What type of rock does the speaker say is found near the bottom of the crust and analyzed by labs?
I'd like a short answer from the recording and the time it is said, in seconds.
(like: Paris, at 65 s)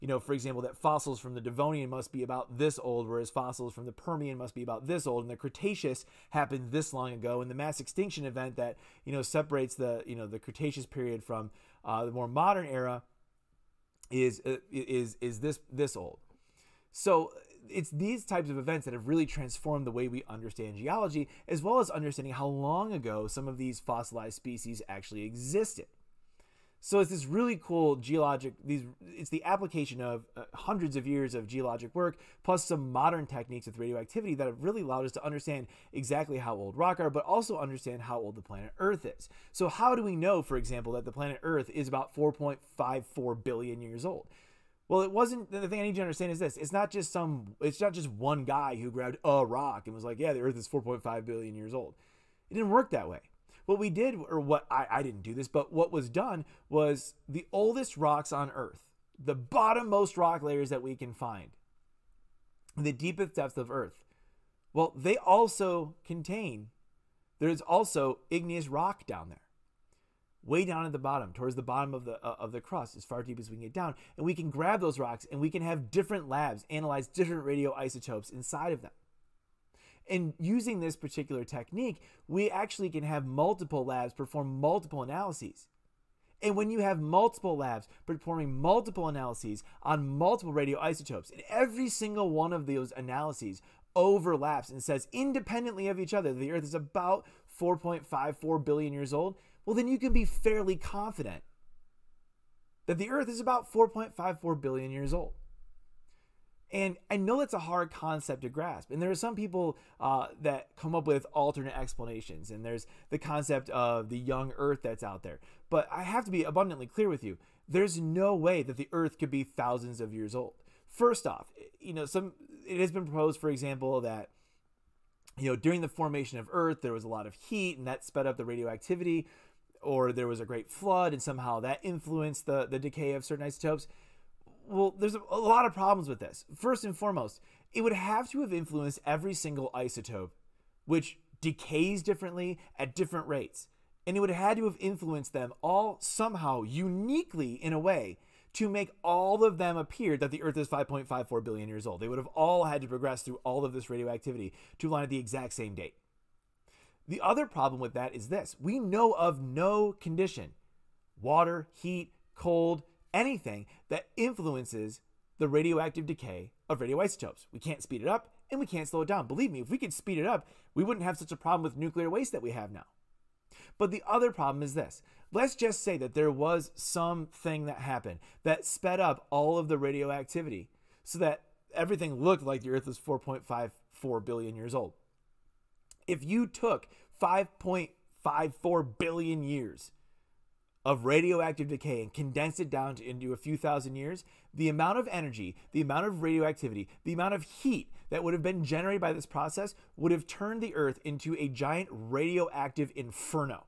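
igneous rock, at 68 s.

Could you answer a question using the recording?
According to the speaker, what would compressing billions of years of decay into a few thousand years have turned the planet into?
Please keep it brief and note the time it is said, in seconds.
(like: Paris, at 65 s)
giant radioactive inferno, at 201 s.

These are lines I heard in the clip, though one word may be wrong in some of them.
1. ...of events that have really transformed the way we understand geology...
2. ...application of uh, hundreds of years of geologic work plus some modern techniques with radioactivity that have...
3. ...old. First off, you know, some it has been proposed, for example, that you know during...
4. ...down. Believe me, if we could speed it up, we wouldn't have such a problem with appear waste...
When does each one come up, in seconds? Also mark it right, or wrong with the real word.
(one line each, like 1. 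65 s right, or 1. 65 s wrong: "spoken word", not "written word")
1. 18 s right
2. 29 s right
3. 120 s right
4. 169 s wrong: "nuclear", not "appear".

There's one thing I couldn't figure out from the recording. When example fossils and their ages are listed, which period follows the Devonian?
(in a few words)
Permian.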